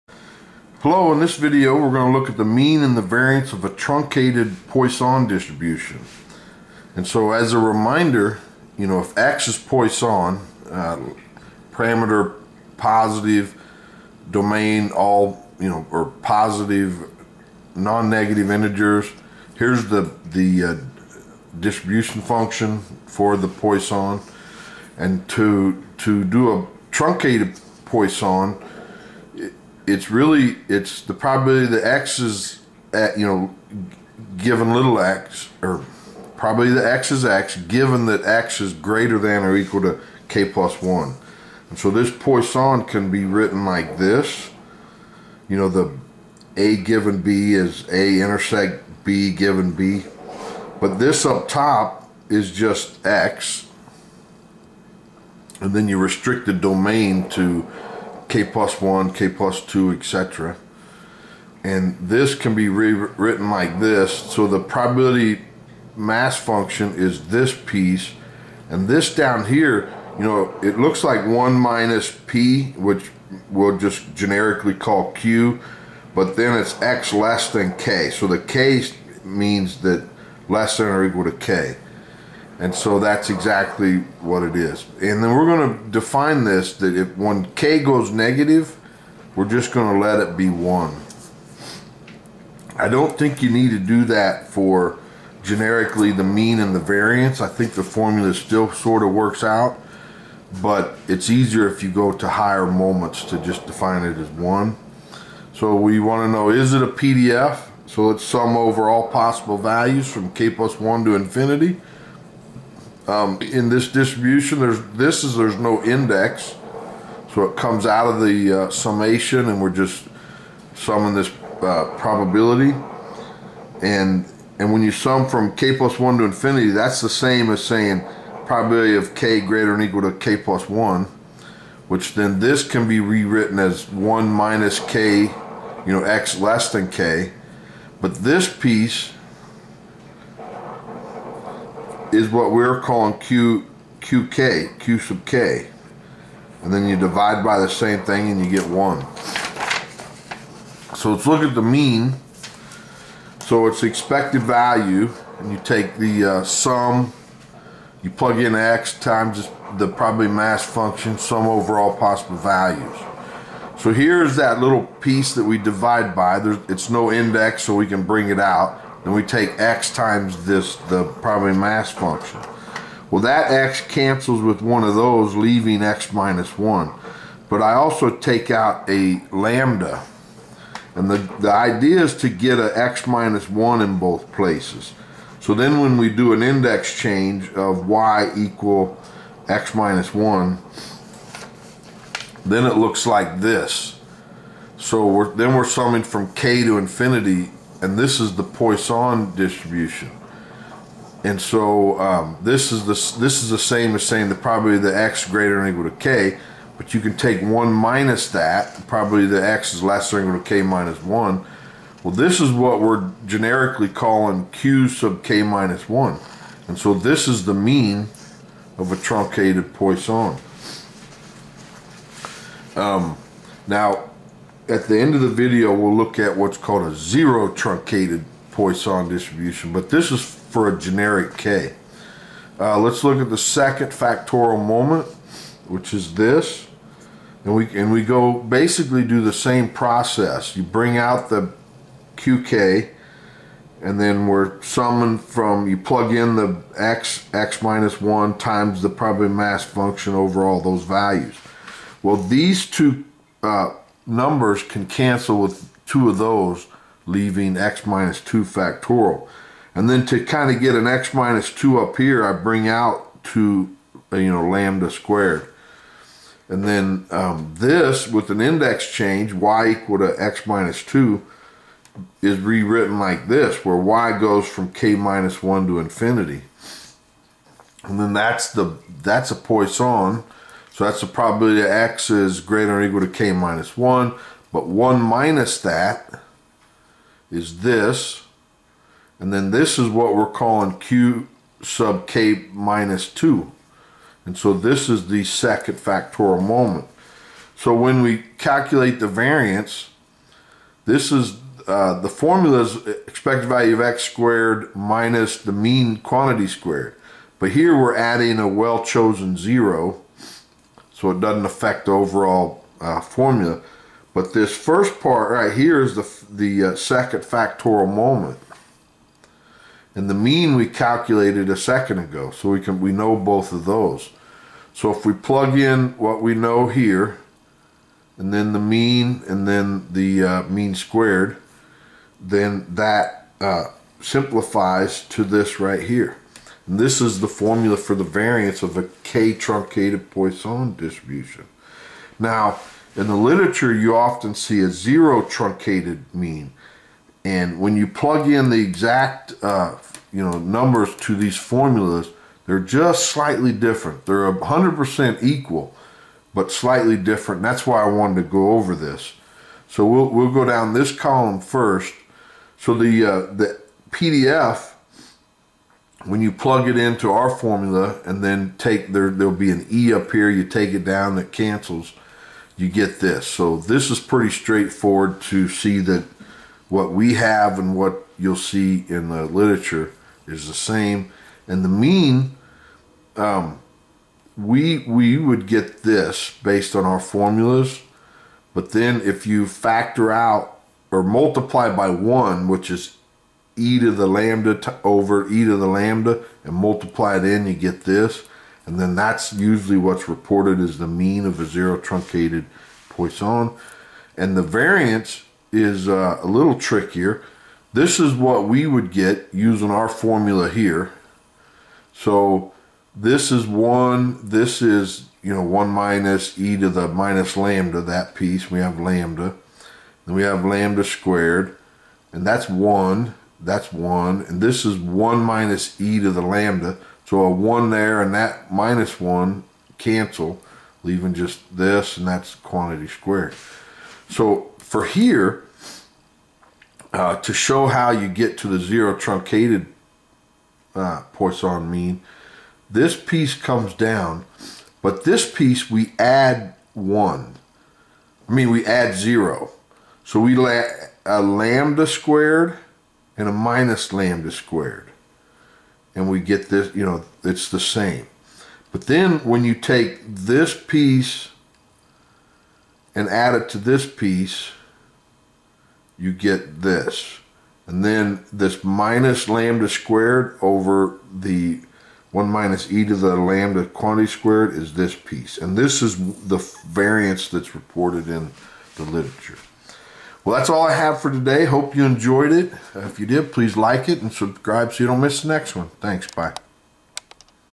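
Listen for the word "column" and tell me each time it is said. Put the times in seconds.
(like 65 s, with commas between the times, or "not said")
360 s.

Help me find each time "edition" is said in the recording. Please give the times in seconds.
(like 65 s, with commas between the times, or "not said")
not said.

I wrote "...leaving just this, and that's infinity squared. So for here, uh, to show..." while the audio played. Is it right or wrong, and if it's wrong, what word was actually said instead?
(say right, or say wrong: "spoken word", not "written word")
wrong: "quantity", not "infinity".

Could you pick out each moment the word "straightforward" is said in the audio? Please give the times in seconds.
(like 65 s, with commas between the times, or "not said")
374 s.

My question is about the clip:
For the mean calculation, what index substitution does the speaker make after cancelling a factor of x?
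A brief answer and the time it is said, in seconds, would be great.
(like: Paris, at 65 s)
y equal x minus 1, at 187 s.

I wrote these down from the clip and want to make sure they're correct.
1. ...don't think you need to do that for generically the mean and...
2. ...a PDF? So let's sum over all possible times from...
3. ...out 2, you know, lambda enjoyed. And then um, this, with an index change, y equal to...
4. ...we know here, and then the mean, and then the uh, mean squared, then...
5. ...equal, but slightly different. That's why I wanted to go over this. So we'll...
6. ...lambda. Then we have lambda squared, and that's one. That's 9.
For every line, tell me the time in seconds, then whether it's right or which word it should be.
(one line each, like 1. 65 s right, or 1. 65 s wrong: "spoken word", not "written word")
1. 92 s right
2. 106 s wrong: "values", not "times"
3. 262 s wrong: "squared", not "enjoyed"
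4. 326 s right
5. 355 s right
6. 418 s wrong: "1", not "9".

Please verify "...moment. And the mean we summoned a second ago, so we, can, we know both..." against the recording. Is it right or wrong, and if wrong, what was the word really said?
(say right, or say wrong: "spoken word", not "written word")
wrong: "calculated", not "summoned".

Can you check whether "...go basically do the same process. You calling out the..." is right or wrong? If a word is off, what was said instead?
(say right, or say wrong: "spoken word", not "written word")
wrong: "bring", not "calling".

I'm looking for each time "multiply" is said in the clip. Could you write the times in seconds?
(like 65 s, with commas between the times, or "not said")
391 s, 396 s.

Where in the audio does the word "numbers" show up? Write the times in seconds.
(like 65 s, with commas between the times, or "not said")
254 s, 350 s.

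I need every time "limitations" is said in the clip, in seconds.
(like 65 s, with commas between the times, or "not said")
not said.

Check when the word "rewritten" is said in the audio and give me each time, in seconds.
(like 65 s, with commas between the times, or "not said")
62 s, 133 s, 272 s.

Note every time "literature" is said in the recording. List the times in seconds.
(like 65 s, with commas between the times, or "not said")
343 s, 379 s, 478 s.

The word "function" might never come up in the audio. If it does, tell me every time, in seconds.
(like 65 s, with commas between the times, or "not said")
22 s, 66 s, 160 s, 171 s, 249 s.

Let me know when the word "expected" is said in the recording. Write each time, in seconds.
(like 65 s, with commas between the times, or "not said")
153 s, 303 s.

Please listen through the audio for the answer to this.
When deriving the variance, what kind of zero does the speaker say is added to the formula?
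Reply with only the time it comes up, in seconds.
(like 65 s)
308 s.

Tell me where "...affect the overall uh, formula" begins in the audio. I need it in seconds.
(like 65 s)
311 s.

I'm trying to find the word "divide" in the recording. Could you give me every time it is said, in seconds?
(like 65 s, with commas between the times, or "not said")
146 s, 165 s.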